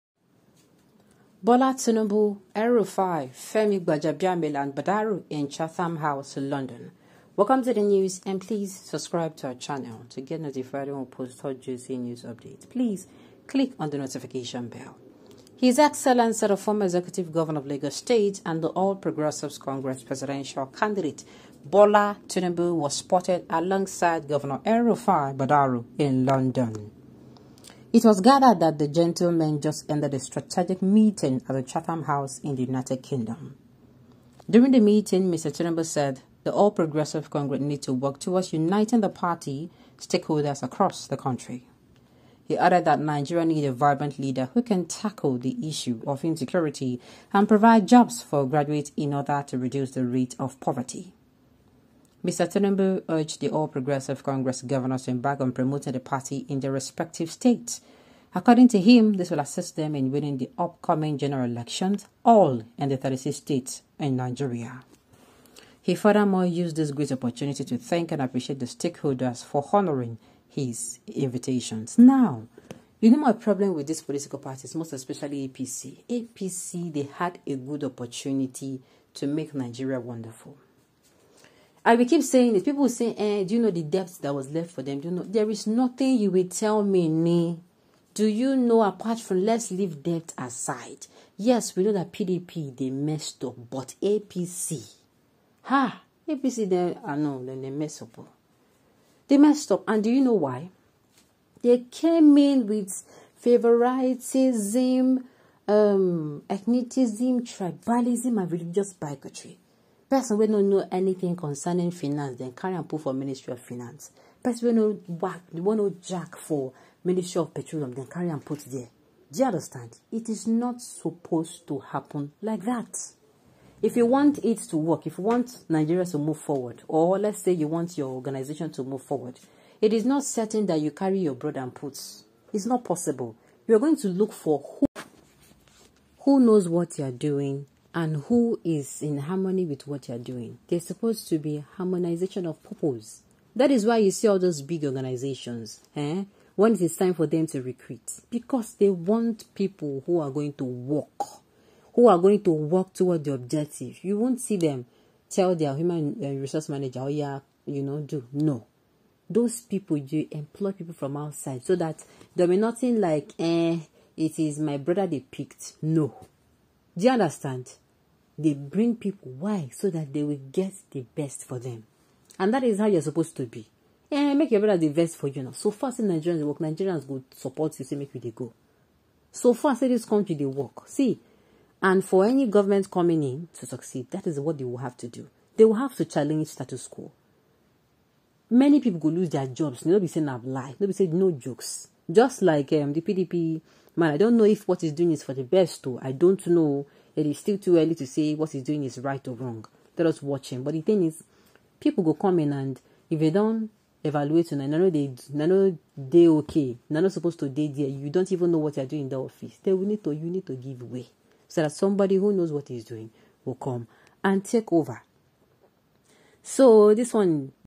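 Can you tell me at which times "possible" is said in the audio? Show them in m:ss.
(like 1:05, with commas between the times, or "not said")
2:12.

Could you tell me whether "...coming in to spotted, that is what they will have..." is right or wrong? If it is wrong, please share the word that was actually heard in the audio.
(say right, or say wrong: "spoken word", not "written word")
wrong: "succeed", not "spotted".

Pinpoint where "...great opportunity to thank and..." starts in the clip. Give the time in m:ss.
1:06.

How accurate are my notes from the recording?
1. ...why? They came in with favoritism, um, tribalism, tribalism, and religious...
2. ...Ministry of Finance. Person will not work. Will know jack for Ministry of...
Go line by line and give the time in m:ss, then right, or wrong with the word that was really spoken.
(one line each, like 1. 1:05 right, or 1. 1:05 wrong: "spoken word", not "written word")
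1. 1:40 wrong: "ethnicism", not "tribalism"
2. 1:53 right.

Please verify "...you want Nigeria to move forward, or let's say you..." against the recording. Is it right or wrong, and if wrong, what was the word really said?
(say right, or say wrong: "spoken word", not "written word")
right.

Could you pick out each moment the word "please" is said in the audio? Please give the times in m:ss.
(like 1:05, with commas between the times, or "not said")
0:08, 0:12.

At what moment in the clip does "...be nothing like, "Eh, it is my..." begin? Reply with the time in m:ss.
2:42.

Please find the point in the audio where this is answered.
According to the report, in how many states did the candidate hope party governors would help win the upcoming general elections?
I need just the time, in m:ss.
1:02.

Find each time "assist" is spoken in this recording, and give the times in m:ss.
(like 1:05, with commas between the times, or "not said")
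0:59.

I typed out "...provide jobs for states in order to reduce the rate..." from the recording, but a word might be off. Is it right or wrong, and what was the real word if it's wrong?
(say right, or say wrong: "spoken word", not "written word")
wrong: "graduates", not "states".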